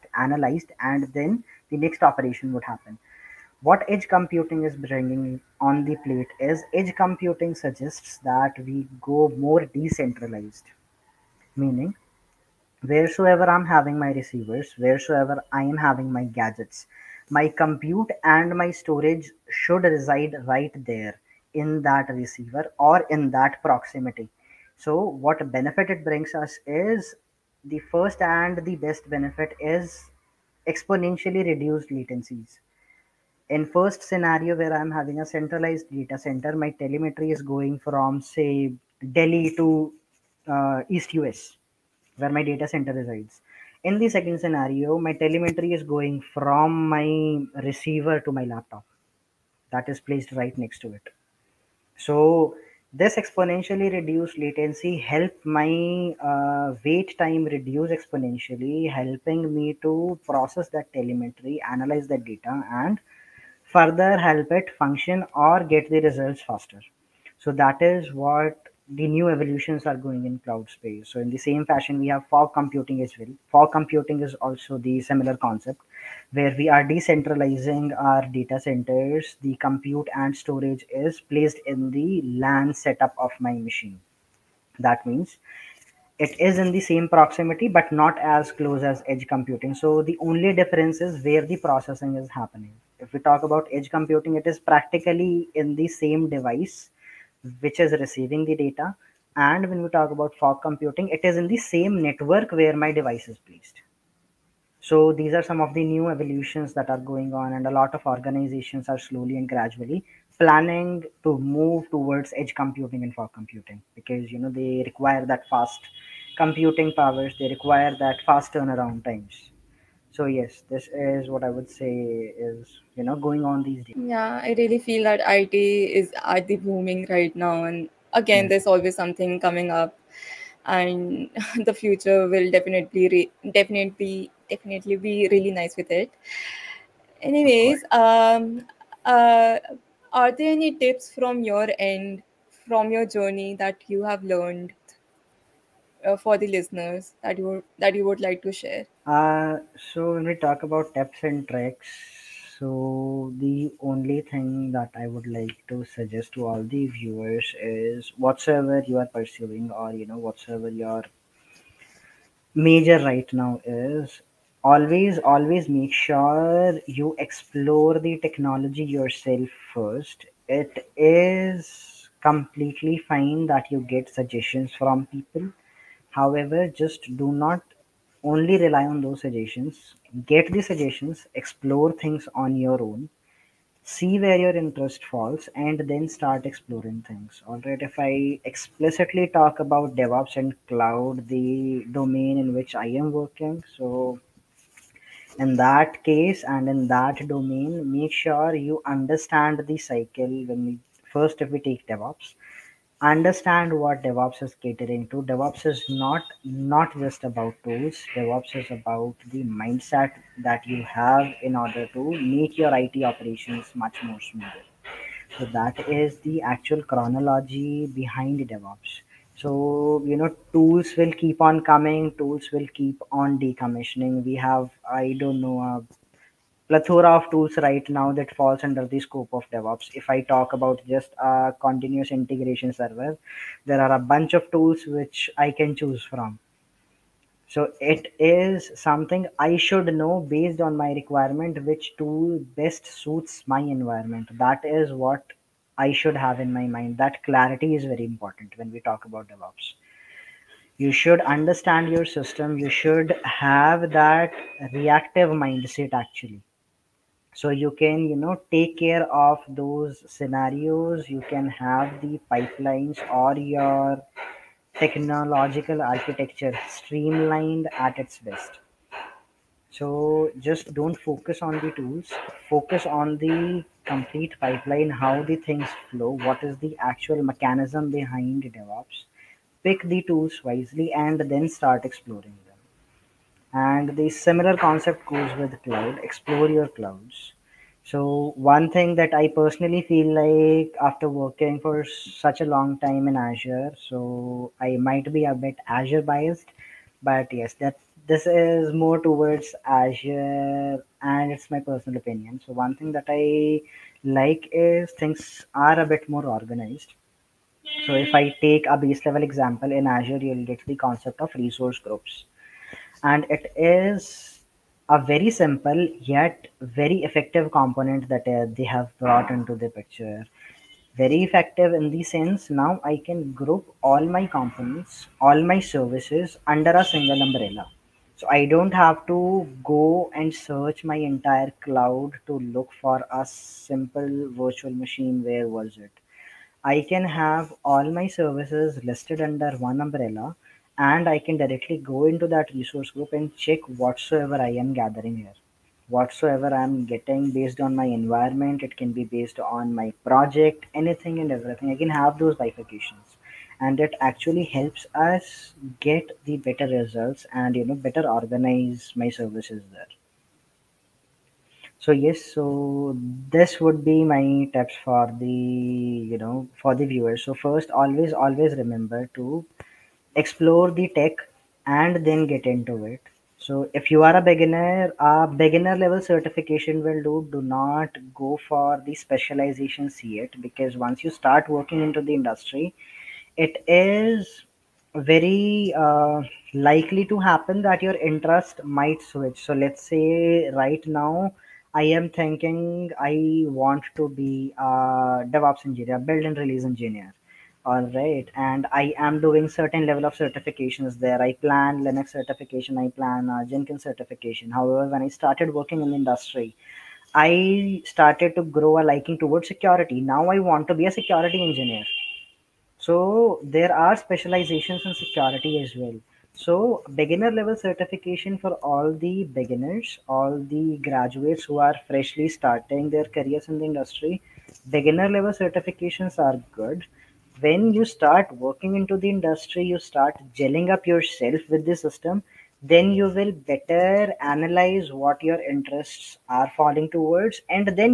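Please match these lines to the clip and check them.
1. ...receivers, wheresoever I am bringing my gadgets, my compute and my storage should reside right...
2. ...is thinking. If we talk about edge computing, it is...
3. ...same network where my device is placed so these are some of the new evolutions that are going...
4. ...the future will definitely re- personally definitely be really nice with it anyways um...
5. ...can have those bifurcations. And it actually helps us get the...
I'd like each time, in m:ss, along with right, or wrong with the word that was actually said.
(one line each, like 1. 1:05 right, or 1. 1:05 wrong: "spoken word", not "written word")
1. 0:14 wrong: "having", not "bringing"
2. 1:32 wrong: "happening", not "thinking"
3. 1:41 right
4. 2:11 wrong: "definitely", not "personally"
5. 5:51 right.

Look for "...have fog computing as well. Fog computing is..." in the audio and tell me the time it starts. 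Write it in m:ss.
1:12.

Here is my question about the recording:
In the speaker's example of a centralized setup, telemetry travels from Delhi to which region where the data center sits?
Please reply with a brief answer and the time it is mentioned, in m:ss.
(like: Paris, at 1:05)
East US, at 0:40.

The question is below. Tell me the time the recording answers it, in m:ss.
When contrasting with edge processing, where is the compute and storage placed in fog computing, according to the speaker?
1:22.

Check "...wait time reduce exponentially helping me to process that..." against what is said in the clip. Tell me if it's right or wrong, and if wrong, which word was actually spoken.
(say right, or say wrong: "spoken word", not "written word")
right.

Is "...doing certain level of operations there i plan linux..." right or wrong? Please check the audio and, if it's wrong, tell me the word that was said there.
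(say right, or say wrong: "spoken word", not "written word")
wrong: "certifications", not "operations".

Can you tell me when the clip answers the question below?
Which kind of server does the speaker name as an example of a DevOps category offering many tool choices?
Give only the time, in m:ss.
3:51.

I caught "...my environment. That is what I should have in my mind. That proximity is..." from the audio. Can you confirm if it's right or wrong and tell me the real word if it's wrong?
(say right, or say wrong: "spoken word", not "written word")
wrong: "clarity", not "proximity".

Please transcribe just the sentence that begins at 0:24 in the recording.
So what benefit it brings us is the first and the best benefit is exponentially reduced latencies.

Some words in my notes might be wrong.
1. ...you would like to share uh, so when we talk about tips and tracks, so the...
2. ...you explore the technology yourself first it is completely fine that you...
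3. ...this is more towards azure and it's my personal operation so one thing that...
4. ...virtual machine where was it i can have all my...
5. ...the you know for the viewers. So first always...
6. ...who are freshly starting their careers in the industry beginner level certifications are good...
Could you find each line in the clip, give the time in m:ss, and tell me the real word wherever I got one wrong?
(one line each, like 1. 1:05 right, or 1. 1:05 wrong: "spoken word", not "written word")
1. 2:27 right
2. 2:46 right
3. 4:58 wrong: "opinion", not "operation"
4. 5:34 right
5. 6:05 right
6. 7:01 right.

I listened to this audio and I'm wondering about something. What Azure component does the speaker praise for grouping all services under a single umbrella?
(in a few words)
Resource groups.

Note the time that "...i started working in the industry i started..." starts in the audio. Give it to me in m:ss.
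6:45.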